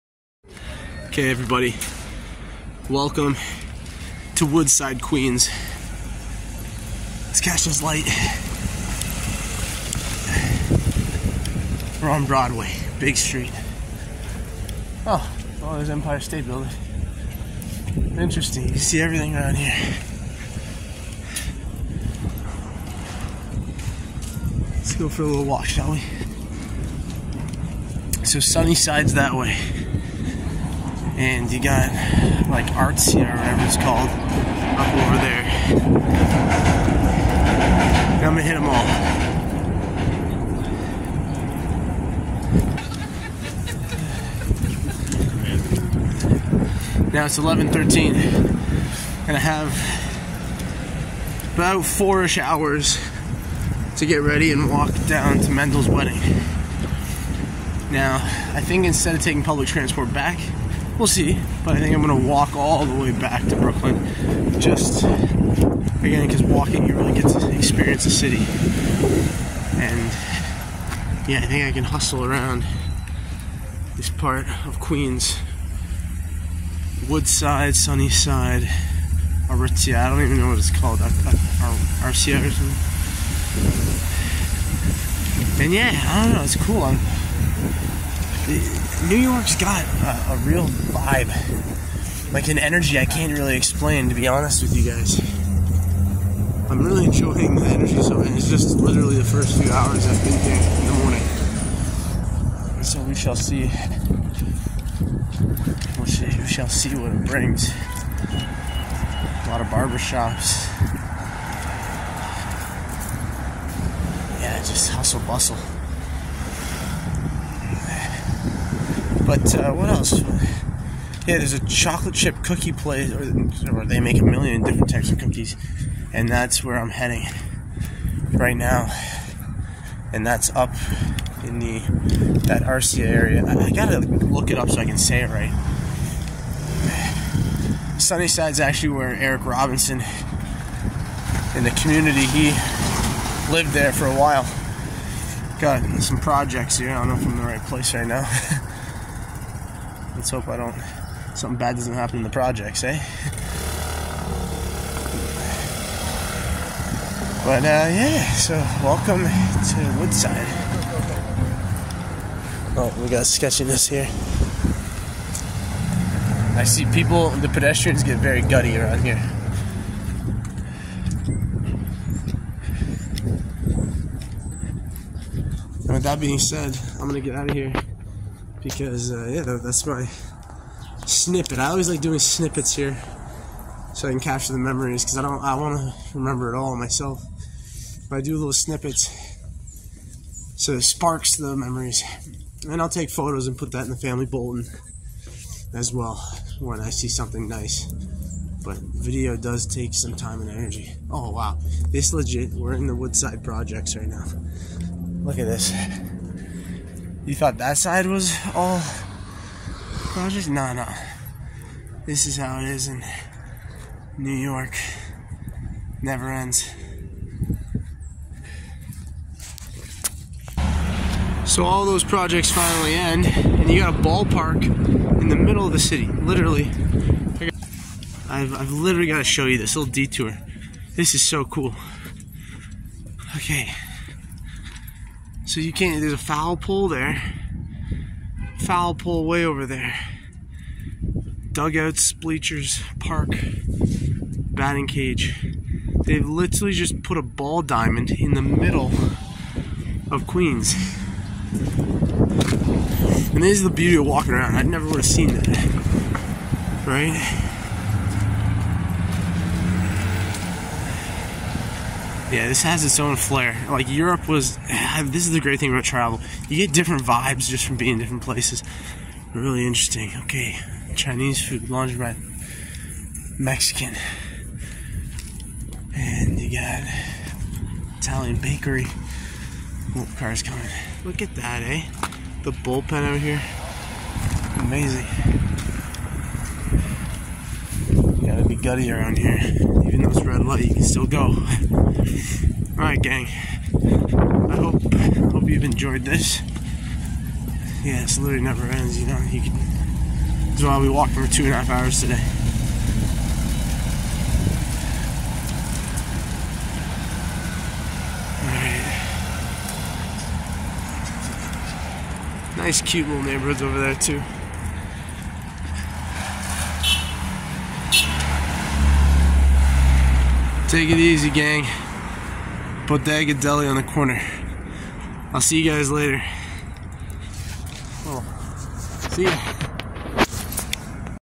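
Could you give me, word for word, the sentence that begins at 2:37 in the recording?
But uh, yeah, so welcome to Woodside.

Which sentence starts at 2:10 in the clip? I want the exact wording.
And that's up in the that Arcia area.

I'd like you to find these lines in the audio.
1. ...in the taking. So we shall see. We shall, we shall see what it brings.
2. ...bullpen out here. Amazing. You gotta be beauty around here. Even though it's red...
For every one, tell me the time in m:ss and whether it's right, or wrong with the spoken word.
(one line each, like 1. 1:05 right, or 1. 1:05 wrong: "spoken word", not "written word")
1. 1:40 wrong: "morning", not "taking"
2. 4:42 wrong: "gutty", not "beauty".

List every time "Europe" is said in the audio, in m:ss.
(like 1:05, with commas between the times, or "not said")
4:23.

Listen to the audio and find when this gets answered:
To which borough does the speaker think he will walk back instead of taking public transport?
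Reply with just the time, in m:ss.
1:03.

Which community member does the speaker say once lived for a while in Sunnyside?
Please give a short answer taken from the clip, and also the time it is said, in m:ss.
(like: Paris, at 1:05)
Eric Robinson, at 2:19.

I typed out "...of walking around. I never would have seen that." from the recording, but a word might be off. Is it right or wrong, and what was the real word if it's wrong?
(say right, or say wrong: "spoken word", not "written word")
right.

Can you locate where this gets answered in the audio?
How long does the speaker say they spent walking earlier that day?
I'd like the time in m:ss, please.
5:01.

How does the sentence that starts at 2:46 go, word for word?
I see people, the pedestrians get very gutty around here.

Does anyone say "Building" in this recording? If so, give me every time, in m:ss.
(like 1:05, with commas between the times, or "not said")
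0:16.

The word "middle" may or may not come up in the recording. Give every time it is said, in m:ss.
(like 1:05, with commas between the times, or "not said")
3:45, 4:08.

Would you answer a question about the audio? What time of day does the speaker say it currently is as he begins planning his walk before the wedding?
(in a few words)
11:13.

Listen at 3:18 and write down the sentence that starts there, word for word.
But video does take some time and energy.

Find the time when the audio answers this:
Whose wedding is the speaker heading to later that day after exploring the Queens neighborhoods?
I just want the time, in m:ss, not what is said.
0:55.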